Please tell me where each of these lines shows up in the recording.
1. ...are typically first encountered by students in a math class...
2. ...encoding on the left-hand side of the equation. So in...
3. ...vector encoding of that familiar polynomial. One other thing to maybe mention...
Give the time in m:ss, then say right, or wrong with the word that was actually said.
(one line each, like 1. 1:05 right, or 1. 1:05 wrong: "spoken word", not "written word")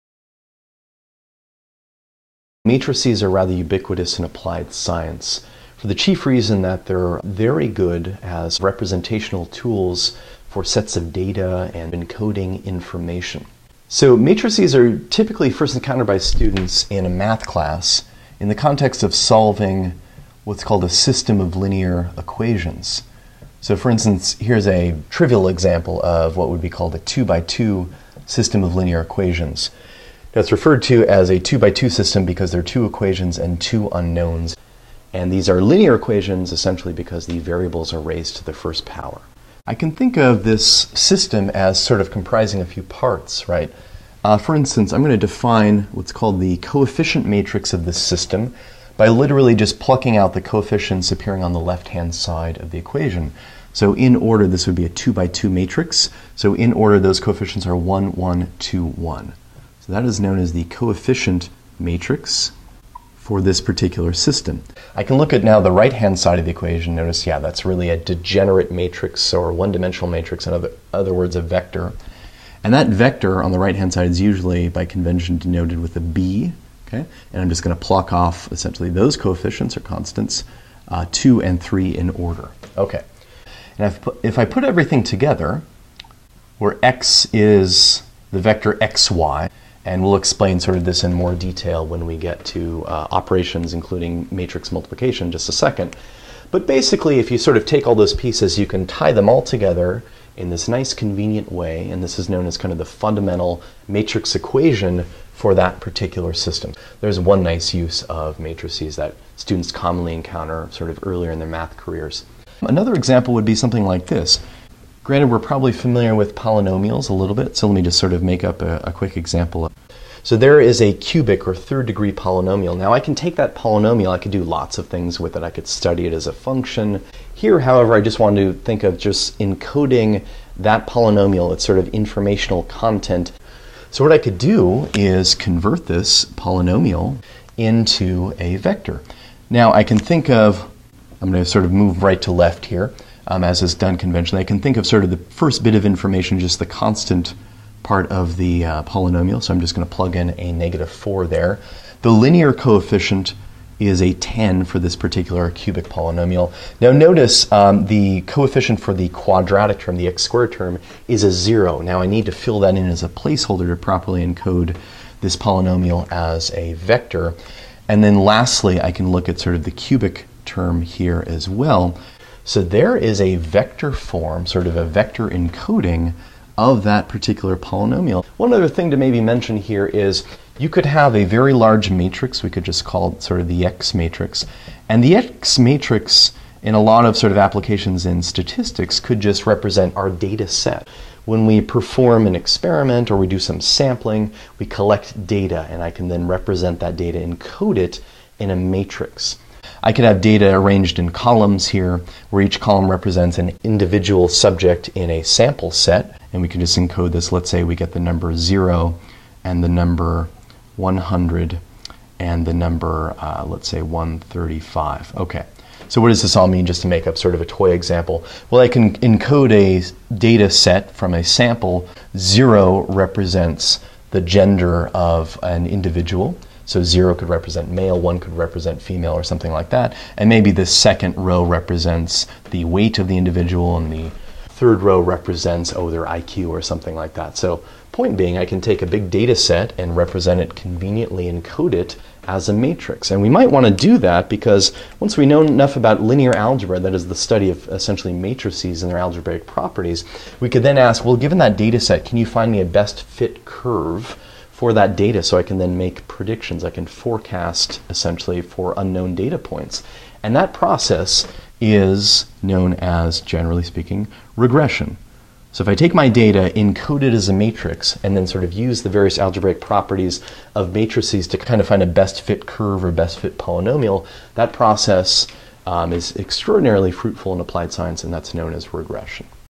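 1. 0:14 right
2. 0:51 wrong: "appearing", not "encoding"
3. 2:54 wrong: "particular", not "familiar".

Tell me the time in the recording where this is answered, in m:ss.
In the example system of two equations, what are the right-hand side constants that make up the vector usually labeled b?
1:21.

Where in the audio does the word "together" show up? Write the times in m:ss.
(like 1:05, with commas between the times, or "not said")
1:25, 1:39.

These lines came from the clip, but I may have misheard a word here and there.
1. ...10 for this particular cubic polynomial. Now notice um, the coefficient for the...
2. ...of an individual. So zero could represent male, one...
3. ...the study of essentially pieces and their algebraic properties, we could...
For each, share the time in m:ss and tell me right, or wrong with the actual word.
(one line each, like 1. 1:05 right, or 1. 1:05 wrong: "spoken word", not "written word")
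1. 2:34 right
2. 3:44 right
3. 4:07 wrong: "matrices", not "pieces".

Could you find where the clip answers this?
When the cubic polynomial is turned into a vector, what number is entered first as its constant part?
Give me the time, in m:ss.
2:30.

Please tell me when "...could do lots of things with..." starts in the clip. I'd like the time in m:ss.
2:04.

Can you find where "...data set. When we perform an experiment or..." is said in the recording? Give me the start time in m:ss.
3:10.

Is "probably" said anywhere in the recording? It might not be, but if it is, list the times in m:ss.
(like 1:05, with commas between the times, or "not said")
1:55.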